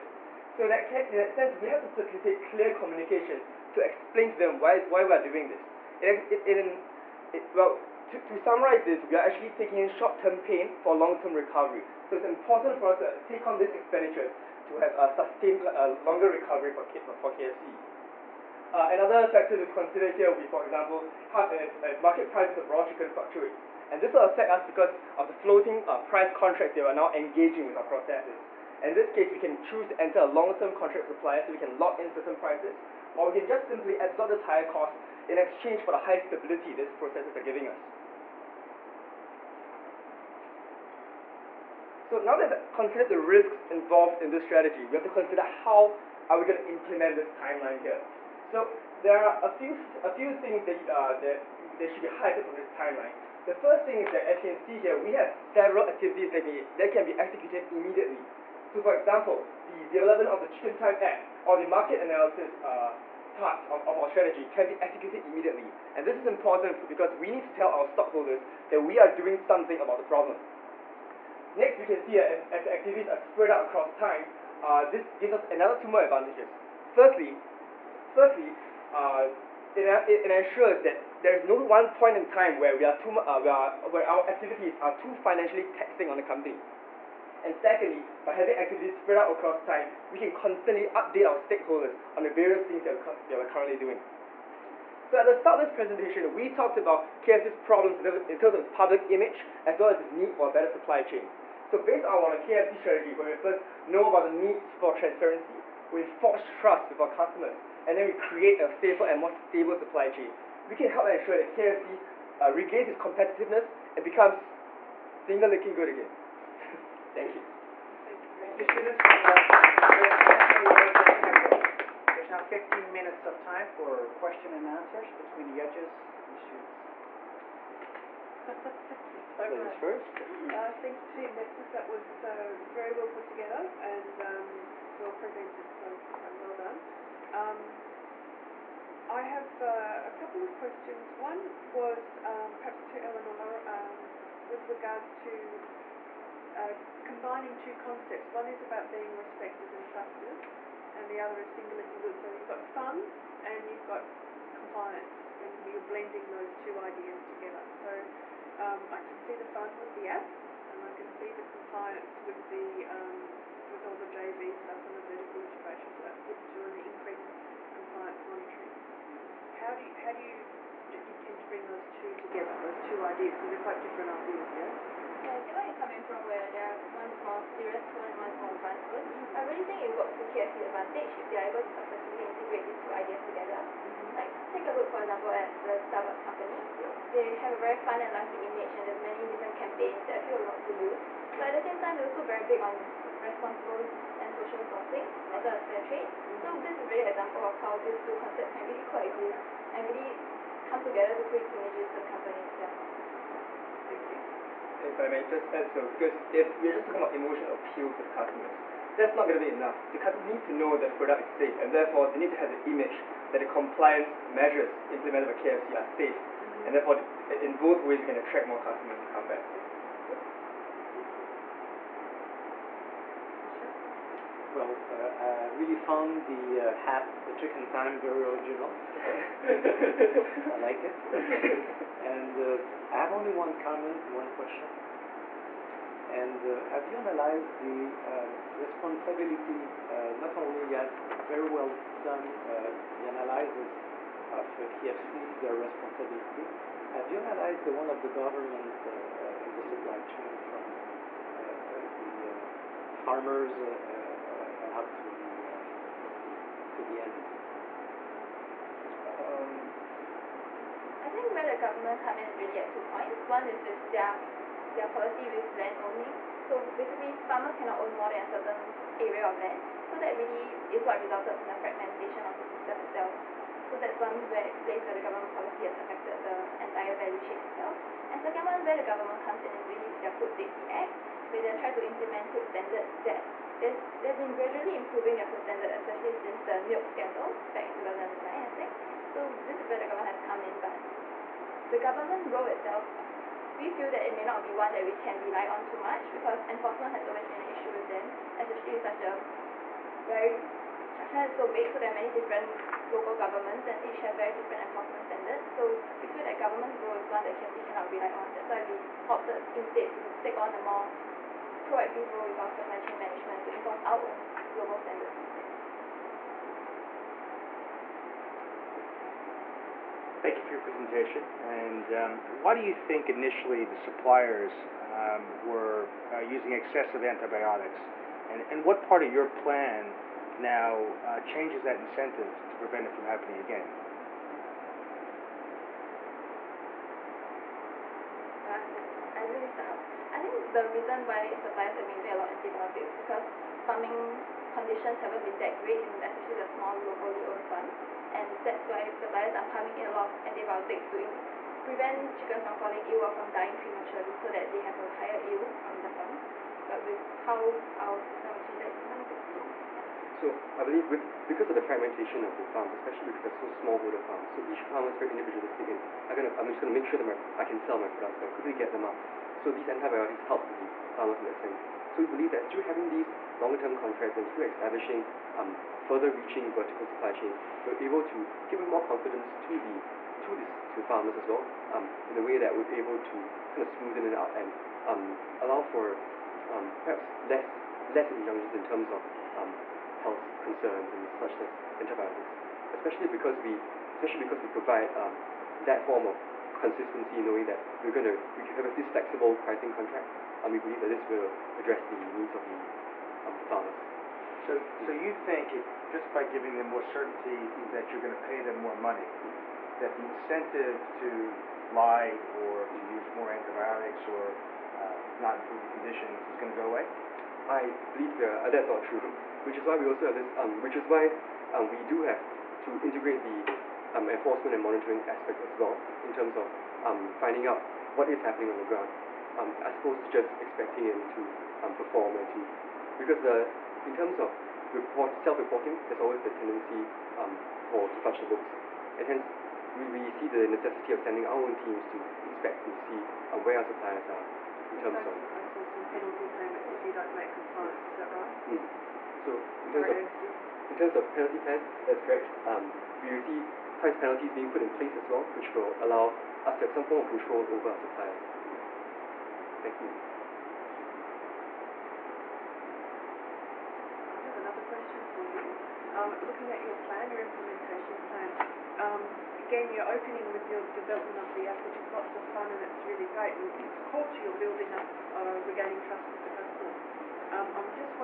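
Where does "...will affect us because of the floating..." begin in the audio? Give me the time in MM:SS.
00:24.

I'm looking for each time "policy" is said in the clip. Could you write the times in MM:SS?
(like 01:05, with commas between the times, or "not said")
04:24, 04:35.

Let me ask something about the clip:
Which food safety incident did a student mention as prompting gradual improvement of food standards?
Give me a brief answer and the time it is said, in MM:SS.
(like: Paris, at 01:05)
The milk scandal, at 04:46.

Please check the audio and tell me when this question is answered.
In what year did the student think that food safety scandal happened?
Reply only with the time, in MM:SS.
04:47.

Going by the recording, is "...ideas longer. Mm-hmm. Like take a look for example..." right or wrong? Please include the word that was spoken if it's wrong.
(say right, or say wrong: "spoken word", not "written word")
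wrong: "together", not "longer".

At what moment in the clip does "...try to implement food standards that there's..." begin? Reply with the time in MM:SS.
04:41.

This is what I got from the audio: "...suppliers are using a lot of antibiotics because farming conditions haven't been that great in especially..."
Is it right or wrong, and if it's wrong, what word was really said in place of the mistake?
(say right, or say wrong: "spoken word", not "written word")
right.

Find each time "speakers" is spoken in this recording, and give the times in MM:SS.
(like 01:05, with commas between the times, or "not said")
not said.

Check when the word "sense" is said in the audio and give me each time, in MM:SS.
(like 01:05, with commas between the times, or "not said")
00:01, 06:11.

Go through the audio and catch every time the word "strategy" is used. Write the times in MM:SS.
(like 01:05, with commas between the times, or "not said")
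00:44, 01:04, 01:42.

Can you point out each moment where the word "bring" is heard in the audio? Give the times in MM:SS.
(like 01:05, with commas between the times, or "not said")
02:51.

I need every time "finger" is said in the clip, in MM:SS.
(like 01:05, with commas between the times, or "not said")
01:55, 02:31.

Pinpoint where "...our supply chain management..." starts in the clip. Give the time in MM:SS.
05:12.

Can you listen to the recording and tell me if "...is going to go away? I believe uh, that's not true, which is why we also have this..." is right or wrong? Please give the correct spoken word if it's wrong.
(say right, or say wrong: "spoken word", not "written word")
right.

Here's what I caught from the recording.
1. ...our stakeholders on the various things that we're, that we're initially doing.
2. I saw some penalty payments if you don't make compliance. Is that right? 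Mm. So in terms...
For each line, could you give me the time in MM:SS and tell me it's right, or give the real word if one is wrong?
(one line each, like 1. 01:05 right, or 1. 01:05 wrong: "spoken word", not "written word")
1. 01:31 wrong: "currently", not "initially"
2. 07:25 right.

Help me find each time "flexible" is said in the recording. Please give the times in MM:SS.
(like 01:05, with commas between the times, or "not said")
06:38.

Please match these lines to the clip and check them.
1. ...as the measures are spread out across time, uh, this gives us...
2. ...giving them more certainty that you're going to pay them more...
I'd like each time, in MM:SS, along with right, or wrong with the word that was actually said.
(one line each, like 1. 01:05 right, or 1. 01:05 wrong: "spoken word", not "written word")
1. 01:12 wrong: "activities", not "measures"
2. 06:46 right.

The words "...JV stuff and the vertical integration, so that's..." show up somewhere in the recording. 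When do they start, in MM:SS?
02:44.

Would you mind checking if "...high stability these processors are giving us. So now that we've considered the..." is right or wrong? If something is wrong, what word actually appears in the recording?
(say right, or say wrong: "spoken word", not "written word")
right.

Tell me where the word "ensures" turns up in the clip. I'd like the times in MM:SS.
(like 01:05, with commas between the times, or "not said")
01:20, 01:51.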